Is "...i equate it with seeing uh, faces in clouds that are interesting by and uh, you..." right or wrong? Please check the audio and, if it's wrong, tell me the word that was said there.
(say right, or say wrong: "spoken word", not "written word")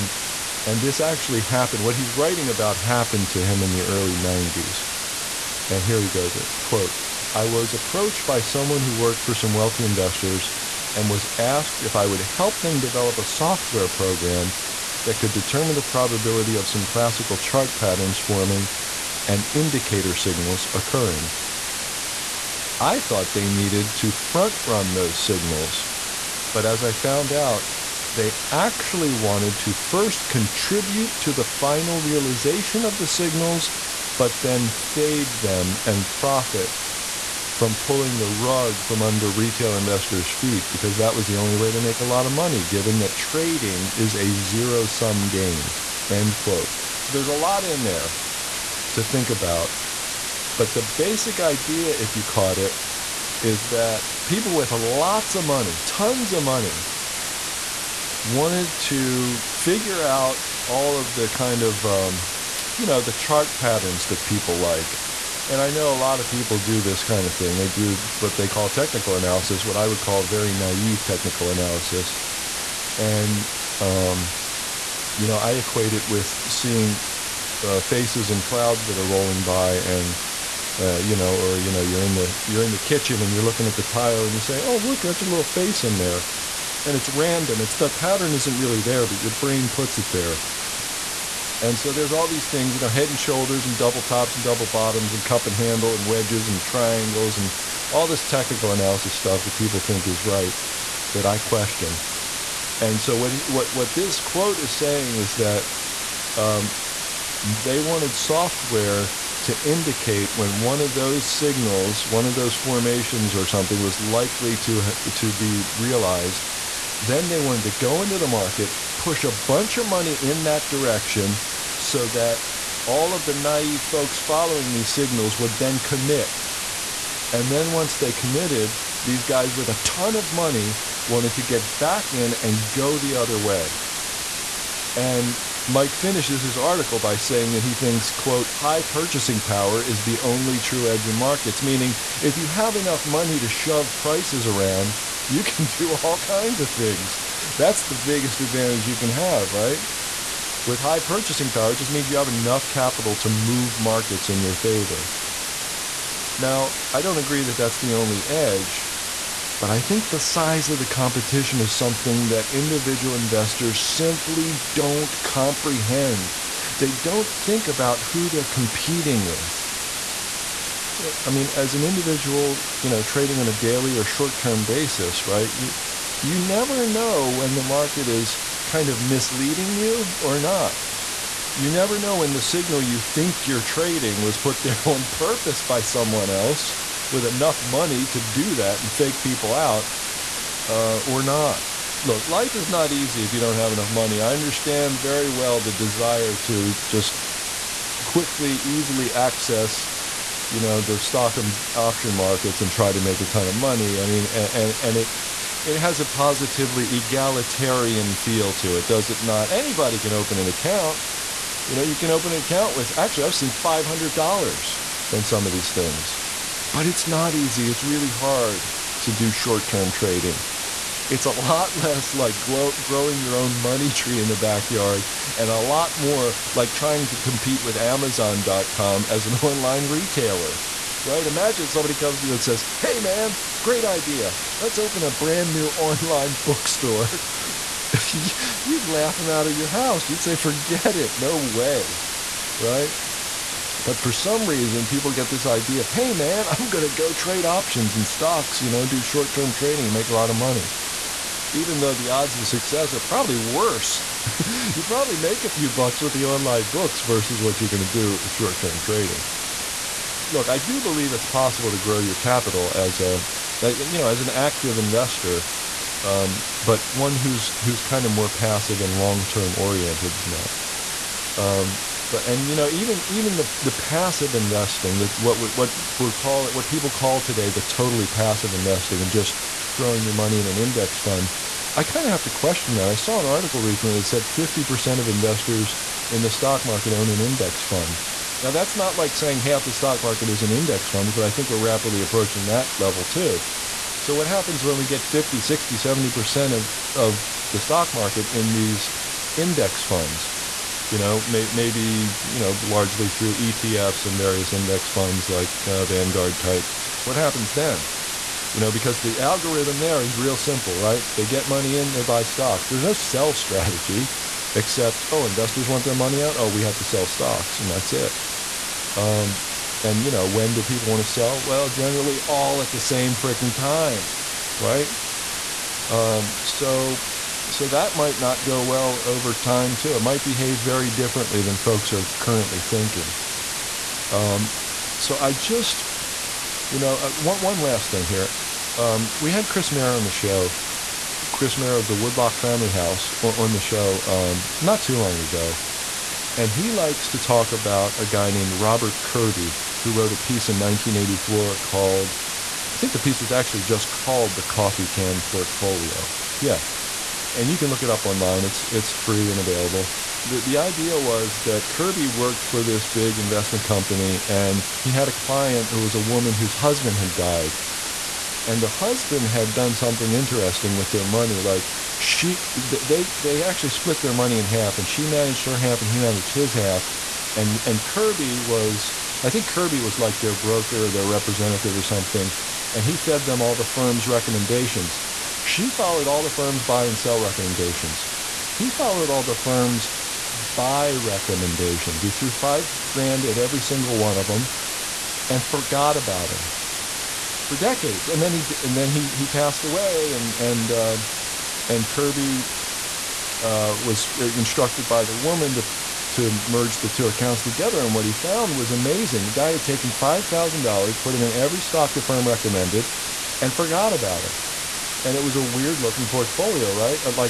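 wrong: "rolling", not "interesting".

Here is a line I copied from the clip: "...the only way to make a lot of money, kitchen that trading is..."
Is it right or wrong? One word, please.
wrong.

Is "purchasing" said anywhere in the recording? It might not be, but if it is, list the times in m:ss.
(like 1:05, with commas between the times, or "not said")
2:18, 2:30.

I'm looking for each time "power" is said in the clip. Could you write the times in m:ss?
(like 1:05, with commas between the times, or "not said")
2:19, 2:31.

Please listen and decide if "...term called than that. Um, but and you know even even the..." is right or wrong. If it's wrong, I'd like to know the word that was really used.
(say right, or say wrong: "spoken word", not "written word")
wrong: "oriented", not "called".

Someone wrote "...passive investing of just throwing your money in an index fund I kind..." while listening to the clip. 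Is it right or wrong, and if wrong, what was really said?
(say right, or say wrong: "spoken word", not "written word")
right.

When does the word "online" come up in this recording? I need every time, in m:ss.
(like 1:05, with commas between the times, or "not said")
3:49, 3:55, 4:16, 5:58.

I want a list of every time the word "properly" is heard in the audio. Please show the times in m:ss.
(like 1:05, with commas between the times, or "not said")
not said.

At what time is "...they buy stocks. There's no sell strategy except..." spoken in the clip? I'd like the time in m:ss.
5:11.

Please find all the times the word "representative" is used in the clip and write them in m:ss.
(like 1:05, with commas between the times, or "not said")
6:21.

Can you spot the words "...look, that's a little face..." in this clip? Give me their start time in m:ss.
1:24.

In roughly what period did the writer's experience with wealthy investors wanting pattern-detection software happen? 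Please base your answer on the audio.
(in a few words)
early 90s.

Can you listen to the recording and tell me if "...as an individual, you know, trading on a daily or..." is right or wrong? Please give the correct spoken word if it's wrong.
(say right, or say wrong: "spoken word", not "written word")
right.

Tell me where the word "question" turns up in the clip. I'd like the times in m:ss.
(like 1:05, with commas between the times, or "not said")
1:41, 4:42.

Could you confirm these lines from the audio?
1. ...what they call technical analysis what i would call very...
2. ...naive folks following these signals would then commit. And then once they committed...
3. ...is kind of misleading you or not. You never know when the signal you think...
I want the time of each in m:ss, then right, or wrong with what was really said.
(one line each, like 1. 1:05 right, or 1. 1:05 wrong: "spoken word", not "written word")
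1. 1:08 right
2. 2:03 right
3. 2:58 right.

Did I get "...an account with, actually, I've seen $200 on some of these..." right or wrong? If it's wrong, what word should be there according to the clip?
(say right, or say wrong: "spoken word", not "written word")
wrong: "500", not "200".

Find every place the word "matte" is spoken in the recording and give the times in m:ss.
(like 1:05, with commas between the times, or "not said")
not said.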